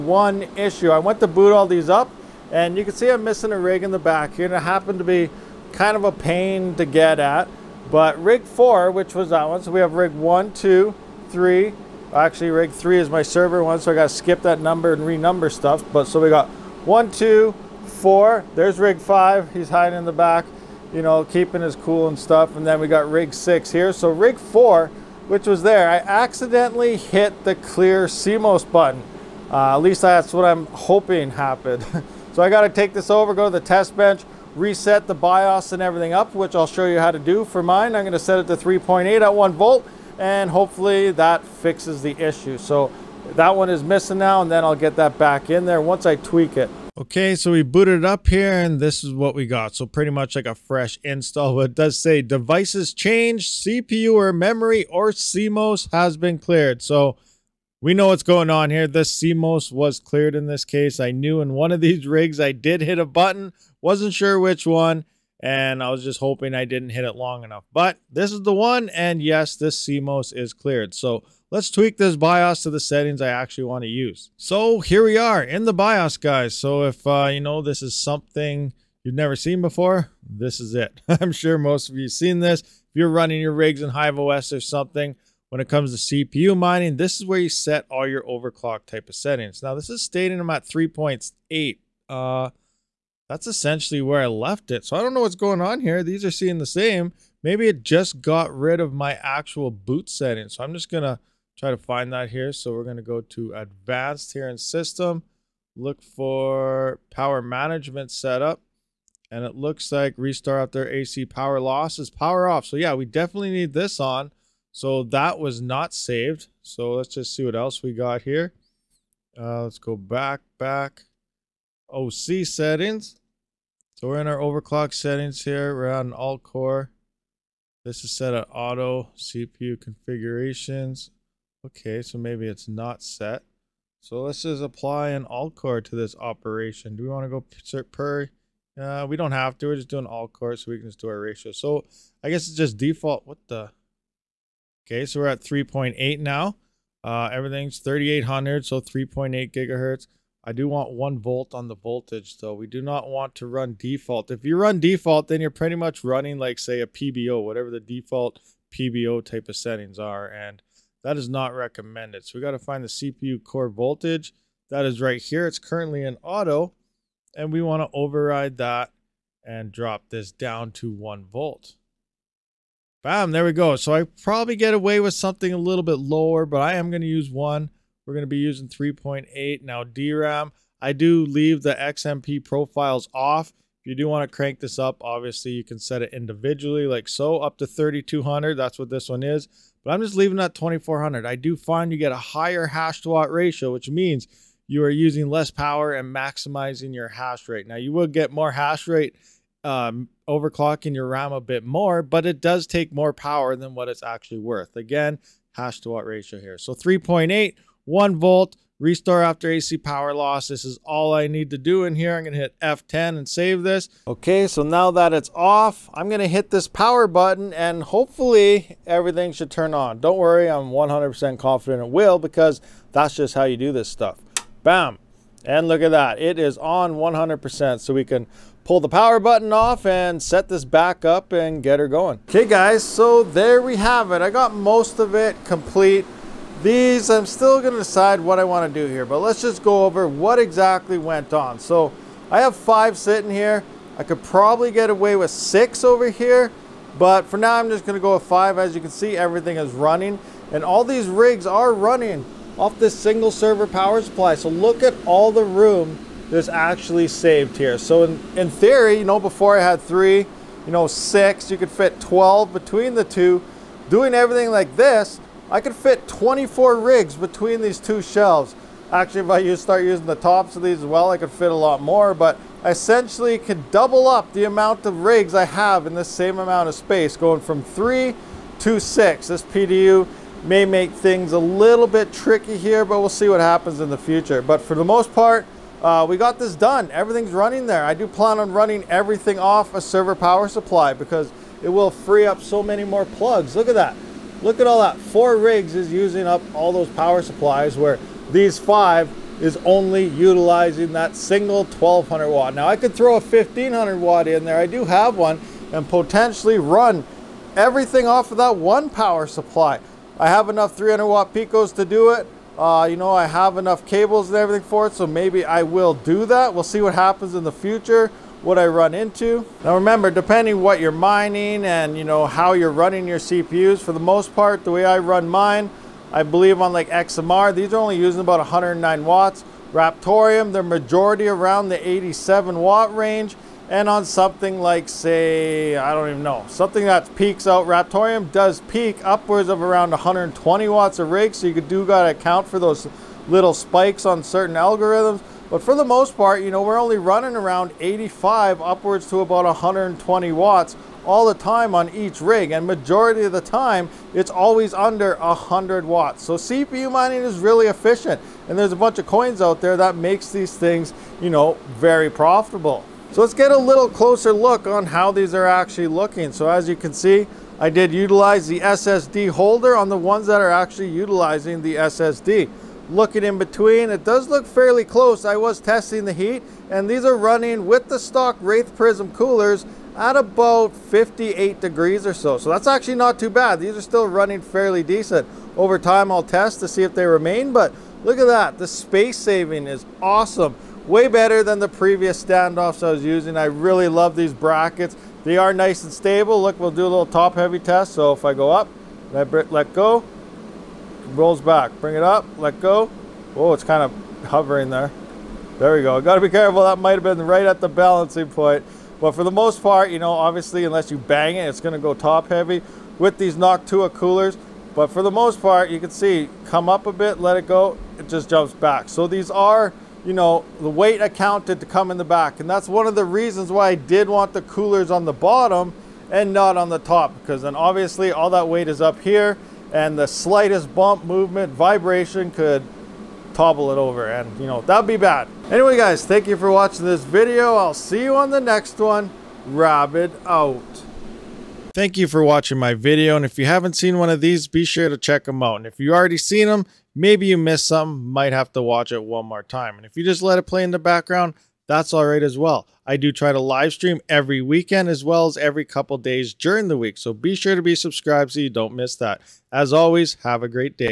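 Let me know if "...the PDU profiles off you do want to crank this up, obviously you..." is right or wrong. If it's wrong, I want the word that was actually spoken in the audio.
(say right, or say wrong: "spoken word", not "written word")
wrong: "XMP", not "PDU".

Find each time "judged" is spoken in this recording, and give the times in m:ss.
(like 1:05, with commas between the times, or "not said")
not said.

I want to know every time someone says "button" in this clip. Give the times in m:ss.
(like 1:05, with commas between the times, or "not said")
0:28, 1:03, 3:37, 3:49.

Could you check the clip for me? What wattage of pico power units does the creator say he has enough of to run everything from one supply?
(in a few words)
300 watts.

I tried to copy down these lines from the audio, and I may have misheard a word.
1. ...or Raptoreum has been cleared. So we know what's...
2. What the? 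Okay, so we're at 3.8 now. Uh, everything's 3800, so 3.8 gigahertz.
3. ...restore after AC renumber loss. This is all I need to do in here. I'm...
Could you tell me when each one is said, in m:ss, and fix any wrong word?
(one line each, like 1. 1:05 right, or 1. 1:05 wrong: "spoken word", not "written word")
1. 0:54 wrong: "CMOS", not "Raptoreum"
2. 2:23 right
3. 3:28 wrong: "power", not "renumber".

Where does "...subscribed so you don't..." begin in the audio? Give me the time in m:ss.
7:37.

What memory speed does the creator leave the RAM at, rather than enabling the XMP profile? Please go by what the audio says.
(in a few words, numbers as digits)
2400.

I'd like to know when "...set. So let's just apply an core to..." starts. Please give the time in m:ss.
2:13.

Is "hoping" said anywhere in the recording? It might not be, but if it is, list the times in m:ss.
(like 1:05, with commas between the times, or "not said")
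0:30, 1:06.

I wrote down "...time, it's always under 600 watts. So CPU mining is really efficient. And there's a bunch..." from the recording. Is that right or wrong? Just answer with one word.
wrong.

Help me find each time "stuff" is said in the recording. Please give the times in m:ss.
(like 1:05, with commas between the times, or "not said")
0:15, 0:22, 3:43.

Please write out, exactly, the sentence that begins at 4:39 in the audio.
This PDU may make things a little bit tricky here, but we'll see what happens in the future.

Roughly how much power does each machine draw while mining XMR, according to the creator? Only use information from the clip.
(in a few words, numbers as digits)
109 watts.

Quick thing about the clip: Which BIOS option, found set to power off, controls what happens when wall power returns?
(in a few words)
Restart after AC power loss.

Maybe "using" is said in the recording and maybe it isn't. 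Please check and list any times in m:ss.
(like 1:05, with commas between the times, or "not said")
2:58, 3:14, 4:29, 4:55, 5:27, 6:33.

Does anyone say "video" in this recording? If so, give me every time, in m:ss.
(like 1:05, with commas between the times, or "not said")
7:17, 7:22.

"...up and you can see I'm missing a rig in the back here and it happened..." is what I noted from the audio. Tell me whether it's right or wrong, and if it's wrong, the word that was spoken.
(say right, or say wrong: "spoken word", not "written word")
right.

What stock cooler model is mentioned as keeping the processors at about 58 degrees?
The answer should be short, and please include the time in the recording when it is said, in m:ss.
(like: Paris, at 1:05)
Wraith Prism, at 6:18.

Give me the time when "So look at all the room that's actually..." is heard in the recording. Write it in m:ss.
4:14.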